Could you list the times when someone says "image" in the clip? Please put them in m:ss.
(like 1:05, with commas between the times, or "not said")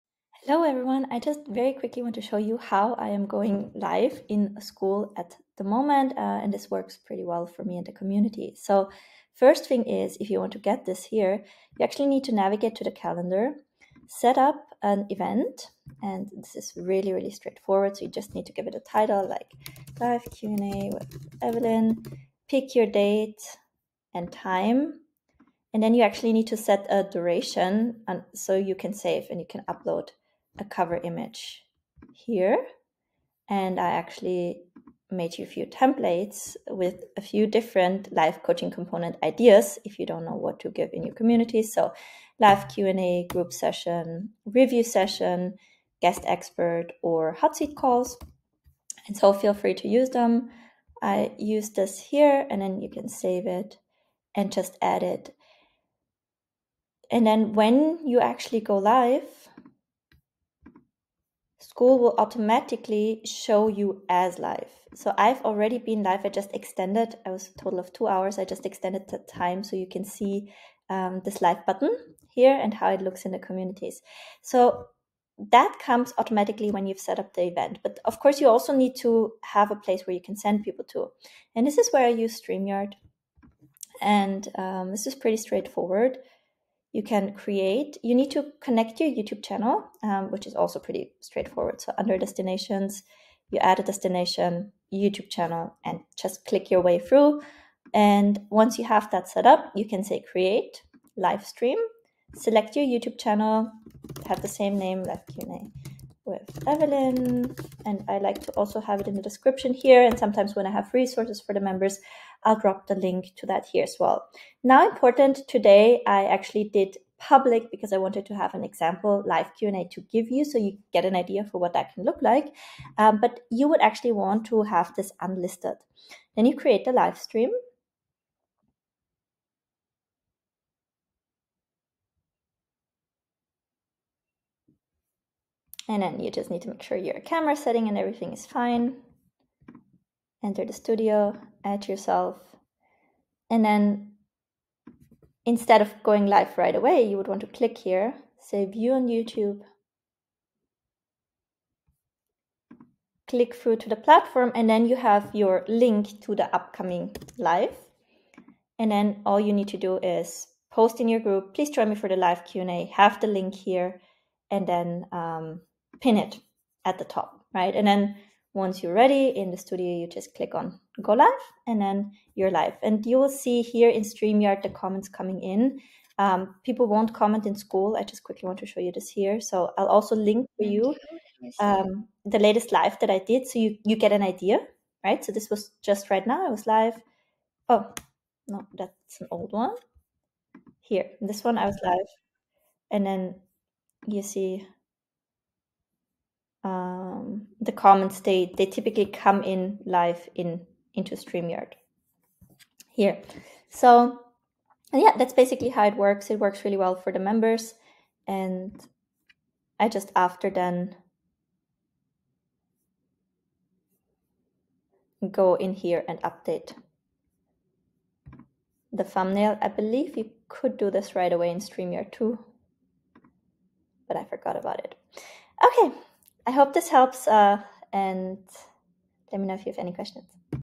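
0:30.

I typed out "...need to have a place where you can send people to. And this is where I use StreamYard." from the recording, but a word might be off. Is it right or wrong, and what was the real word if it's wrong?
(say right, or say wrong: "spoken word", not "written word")
right.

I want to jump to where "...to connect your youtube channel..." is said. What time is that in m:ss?
1:28.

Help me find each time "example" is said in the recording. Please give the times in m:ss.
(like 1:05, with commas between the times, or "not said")
1:58.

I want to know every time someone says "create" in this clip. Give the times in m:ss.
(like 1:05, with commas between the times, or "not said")
1:27, 1:40, 2:06.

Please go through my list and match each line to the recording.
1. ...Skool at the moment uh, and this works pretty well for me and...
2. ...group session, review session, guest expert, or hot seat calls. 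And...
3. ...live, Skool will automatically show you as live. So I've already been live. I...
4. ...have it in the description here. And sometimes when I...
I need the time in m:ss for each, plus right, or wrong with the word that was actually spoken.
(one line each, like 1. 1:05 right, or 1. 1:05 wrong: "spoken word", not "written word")
1. 0:04 right
2. 0:43 right
3. 0:58 right
4. 1:48 right.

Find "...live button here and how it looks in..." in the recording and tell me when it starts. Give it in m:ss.
1:11.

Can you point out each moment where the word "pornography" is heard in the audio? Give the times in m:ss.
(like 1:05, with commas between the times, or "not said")
not said.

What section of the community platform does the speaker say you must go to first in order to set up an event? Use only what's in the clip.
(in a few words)
calendar.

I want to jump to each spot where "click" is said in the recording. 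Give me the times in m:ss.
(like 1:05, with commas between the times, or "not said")
1:36, 2:27, 2:33, 2:50.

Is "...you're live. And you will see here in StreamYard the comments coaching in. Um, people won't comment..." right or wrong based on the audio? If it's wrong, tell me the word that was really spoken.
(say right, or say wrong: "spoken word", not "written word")
wrong: "coming", not "coaching".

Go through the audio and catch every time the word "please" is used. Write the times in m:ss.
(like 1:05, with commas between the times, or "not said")
2:41.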